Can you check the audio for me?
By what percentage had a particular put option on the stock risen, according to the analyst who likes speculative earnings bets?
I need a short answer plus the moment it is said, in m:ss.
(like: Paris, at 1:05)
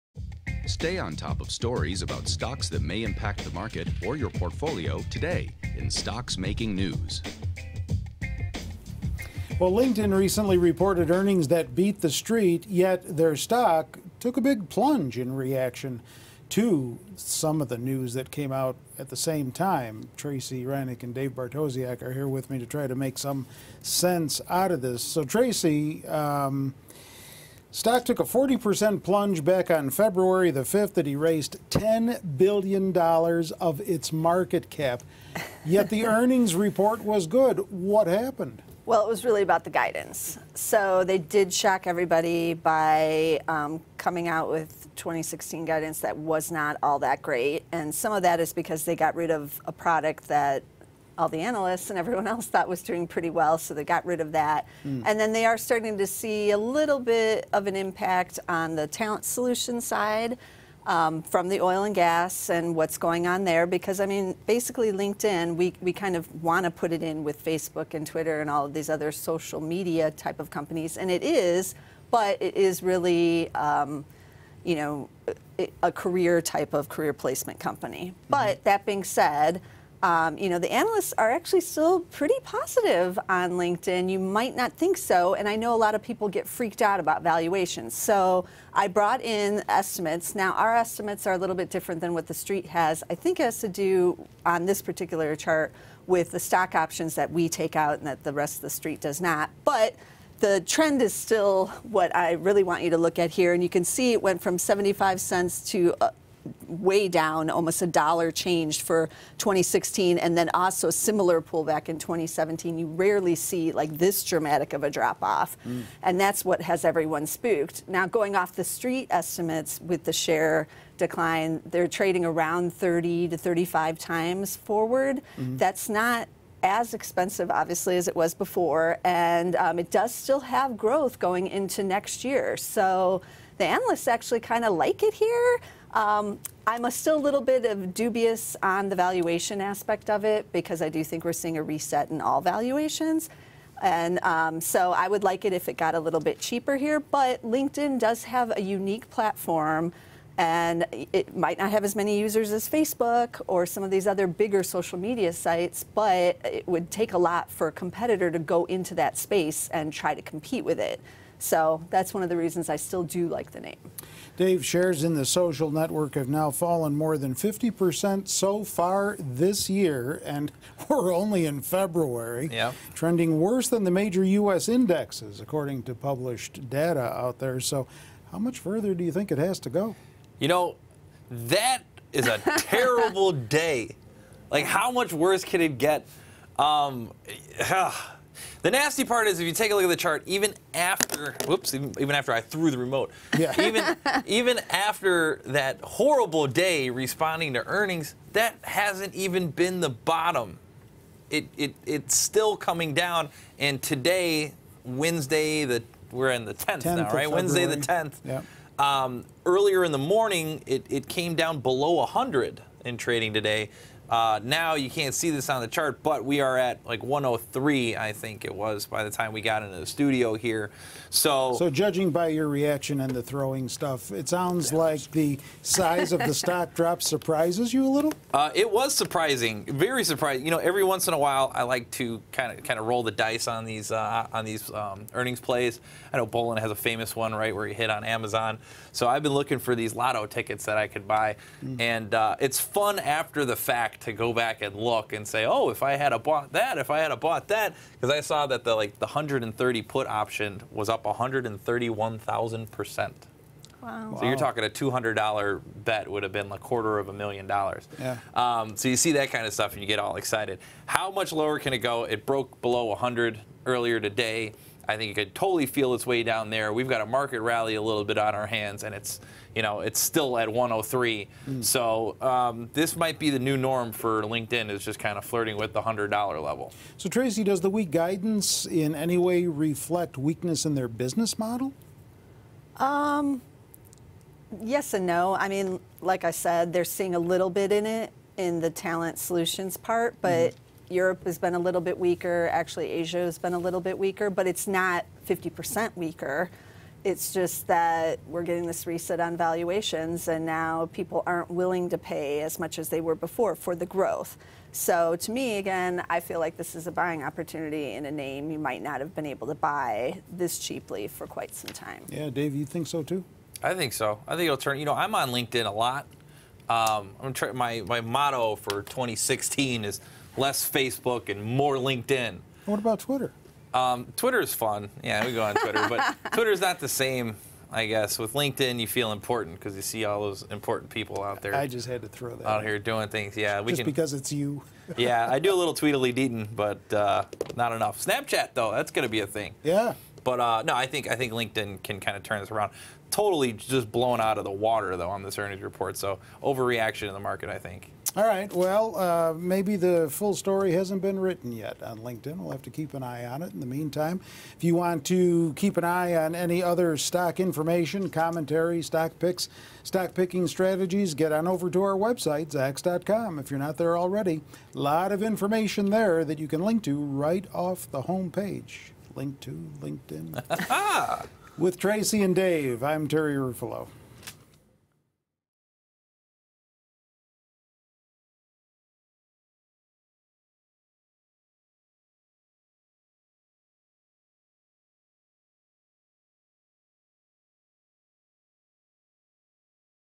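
131,000 percent, at 4:11.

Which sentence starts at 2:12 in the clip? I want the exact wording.
So the analysts actually kind of like it here.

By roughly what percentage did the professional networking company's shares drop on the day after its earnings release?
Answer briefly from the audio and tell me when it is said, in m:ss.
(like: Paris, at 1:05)
40%, at 0:28.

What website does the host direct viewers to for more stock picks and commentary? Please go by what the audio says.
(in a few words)
zacks.com.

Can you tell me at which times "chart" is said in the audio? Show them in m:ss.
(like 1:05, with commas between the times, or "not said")
1:35, 3:09, 3:35.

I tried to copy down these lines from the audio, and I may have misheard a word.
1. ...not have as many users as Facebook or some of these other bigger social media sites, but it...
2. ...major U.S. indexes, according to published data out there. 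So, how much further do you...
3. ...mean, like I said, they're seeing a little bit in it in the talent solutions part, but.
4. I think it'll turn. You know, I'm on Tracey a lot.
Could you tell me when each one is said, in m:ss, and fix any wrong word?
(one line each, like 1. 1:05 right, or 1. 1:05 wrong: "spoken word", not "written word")
1. 2:31 right
2. 2:53 right
3. 4:45 right
4. 5:14 wrong: "LinkedIn", not "Tracey".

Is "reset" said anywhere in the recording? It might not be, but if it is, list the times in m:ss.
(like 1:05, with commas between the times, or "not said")
2:21, 4:58.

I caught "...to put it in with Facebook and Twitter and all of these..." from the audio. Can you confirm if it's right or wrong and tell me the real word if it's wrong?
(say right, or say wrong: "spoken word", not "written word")
right.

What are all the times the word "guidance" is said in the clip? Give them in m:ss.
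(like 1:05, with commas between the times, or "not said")
0:39, 0:45, 4:37.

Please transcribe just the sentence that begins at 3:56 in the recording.
I know Bolan has a famous one, right, where he hit on Amazon.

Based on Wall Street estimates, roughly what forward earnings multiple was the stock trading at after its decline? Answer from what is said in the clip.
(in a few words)
30 to 35 times.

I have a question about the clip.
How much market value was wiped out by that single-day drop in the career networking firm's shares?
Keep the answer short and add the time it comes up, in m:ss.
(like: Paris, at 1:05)
$10 billion, at 0:31.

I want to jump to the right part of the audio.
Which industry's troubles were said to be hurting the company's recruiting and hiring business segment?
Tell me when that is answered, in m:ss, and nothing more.
1:01.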